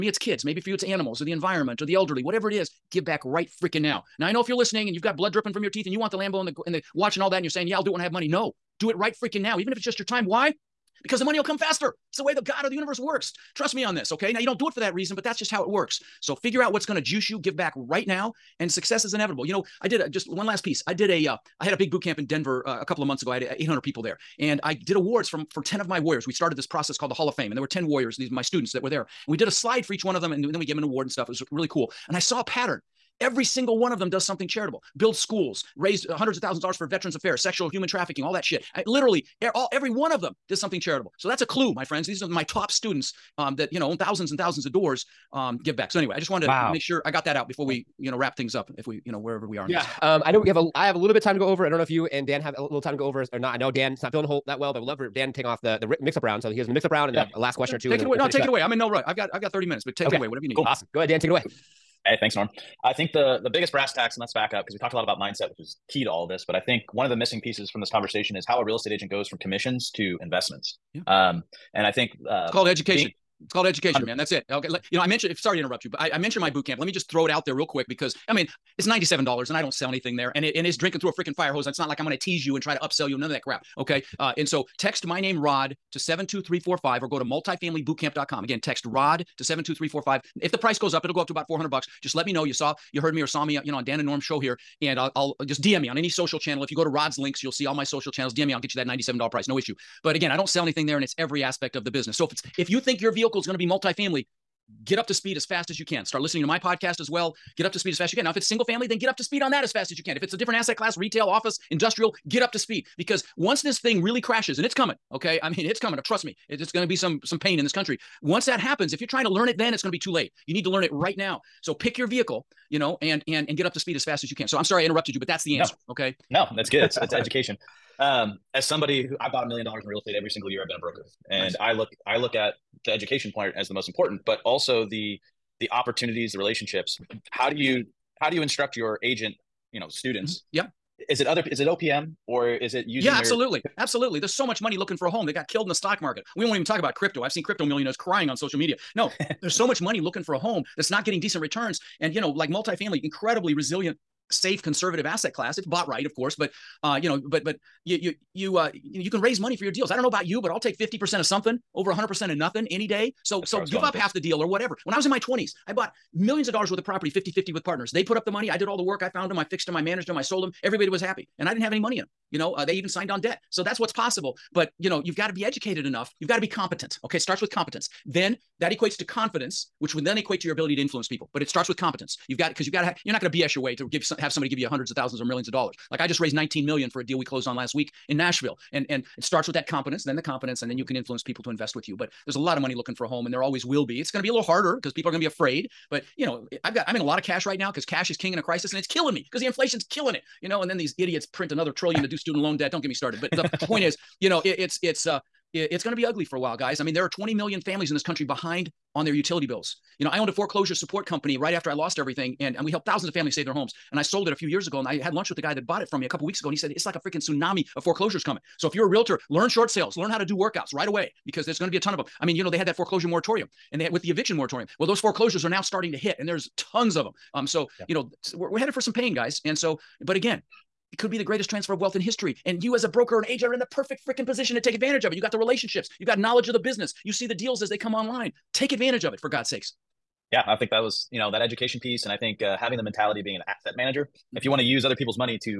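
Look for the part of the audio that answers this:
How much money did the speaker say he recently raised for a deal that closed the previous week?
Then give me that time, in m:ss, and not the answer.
3:06.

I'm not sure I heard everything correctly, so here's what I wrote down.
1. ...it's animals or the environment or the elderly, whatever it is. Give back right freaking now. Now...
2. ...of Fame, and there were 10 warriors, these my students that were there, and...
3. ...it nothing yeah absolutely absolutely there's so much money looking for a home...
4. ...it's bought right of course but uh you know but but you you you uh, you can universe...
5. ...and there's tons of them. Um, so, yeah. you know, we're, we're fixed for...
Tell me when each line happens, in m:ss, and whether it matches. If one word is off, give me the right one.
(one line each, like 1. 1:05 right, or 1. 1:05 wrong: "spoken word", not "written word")
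1. 0:00 right
2. 0:27 right
3. 2:22 wrong: "using", not "nothing"
4. 2:35 wrong: "raise", not "universe"
5. 3:46 wrong: "headed", not "fixed".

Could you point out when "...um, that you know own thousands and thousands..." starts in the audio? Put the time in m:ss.
0:43.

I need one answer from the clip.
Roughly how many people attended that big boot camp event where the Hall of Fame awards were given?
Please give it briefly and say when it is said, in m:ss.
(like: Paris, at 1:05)
800, at 0:23.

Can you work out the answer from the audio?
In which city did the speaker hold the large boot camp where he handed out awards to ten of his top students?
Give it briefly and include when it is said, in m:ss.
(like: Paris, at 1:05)
Denver, at 0:22.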